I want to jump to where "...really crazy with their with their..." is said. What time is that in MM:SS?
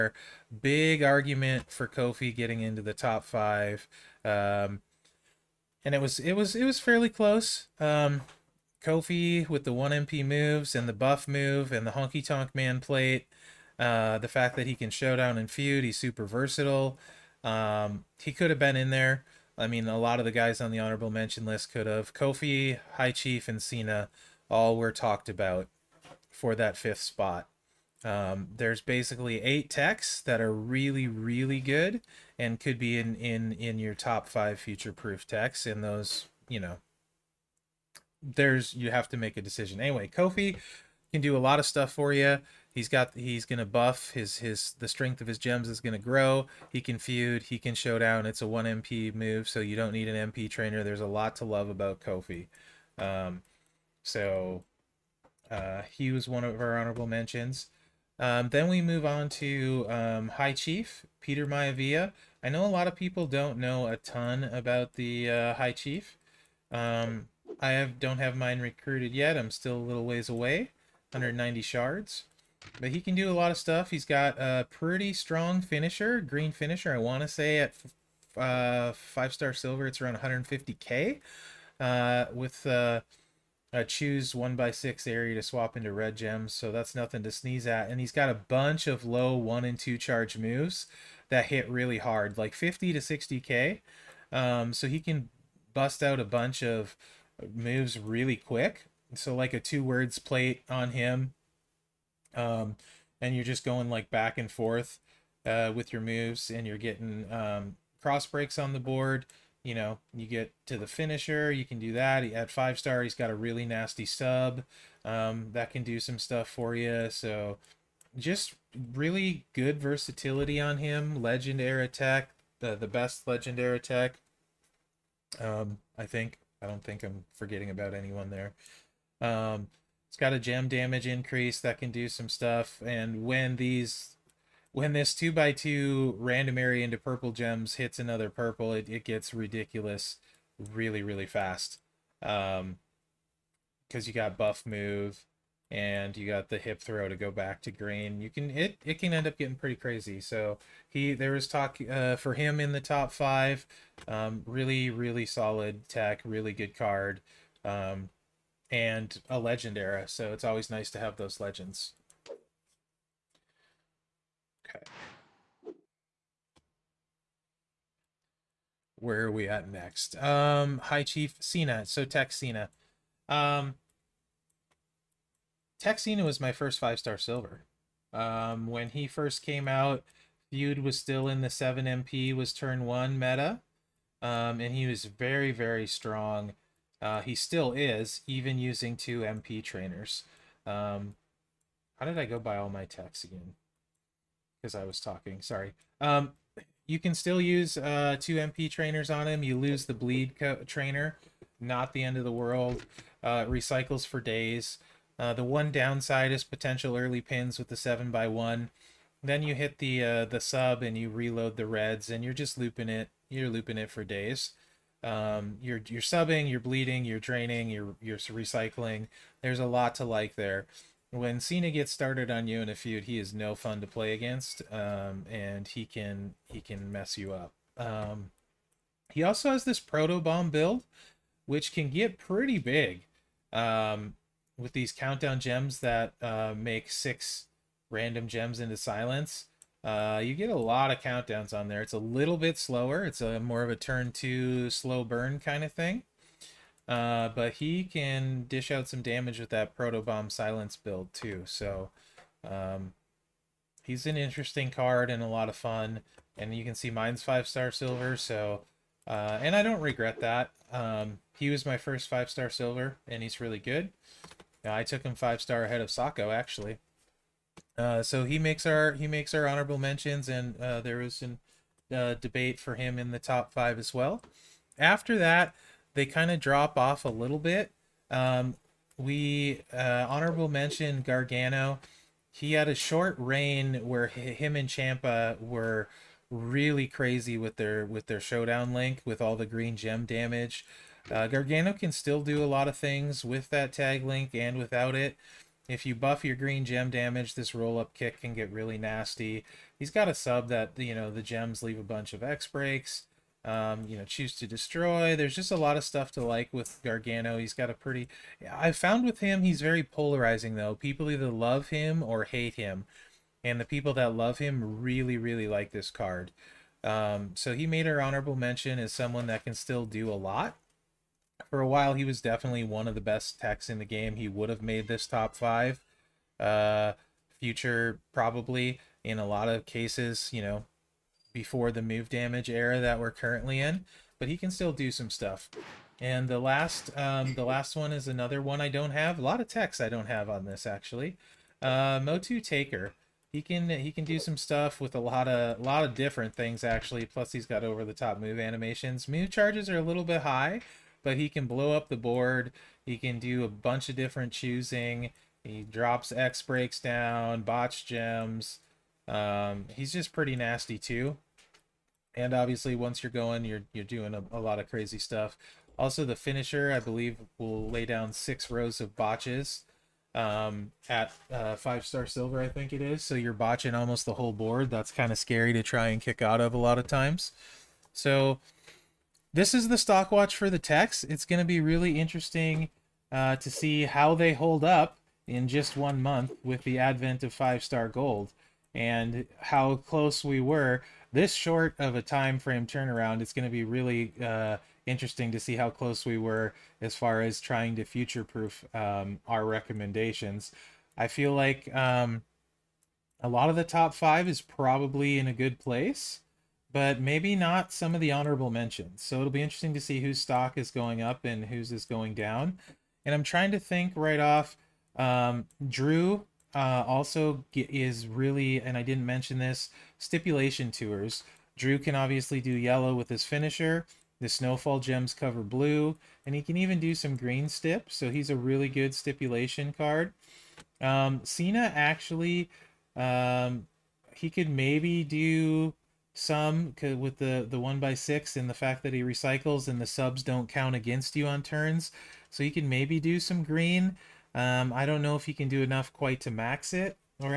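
04:46.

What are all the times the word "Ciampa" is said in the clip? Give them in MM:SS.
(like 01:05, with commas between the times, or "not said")
04:44.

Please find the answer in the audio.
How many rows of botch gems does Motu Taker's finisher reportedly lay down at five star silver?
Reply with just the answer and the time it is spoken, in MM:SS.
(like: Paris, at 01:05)
6, at 06:08.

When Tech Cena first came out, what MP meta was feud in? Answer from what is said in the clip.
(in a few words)
7 MP.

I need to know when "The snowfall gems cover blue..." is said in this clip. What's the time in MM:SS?
07:04.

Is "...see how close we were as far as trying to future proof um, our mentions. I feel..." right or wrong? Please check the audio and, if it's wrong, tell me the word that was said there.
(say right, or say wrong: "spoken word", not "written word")
wrong: "recommendations", not "mentions".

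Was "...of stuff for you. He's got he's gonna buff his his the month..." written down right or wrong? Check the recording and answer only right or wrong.
wrong.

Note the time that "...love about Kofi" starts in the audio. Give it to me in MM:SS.
00:51.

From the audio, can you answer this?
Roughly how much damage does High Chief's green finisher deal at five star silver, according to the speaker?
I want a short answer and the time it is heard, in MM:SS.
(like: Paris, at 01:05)
150k, at 01:20.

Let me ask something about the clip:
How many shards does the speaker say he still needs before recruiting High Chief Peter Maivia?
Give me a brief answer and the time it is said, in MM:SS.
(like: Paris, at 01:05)
190, at 01:11.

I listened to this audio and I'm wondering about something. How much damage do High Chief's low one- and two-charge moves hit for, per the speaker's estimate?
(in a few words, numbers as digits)
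50 to 60k.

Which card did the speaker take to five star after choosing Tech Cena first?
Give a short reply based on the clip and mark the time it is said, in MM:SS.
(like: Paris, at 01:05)
Sako, at 04:25.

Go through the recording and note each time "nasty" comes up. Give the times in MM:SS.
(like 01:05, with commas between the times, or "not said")
01:53, 04:58, 06:00.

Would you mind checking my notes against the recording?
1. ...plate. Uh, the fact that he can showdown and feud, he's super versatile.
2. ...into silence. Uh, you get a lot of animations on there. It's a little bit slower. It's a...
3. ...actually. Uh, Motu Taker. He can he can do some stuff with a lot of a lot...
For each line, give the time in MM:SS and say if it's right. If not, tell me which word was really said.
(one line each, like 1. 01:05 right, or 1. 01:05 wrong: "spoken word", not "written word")
1. 00:12 right
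2. 03:58 wrong: "countdowns", not "animations"
3. 05:40 right.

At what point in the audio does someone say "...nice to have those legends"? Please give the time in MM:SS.
02:40.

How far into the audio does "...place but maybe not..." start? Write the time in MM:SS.
06:45.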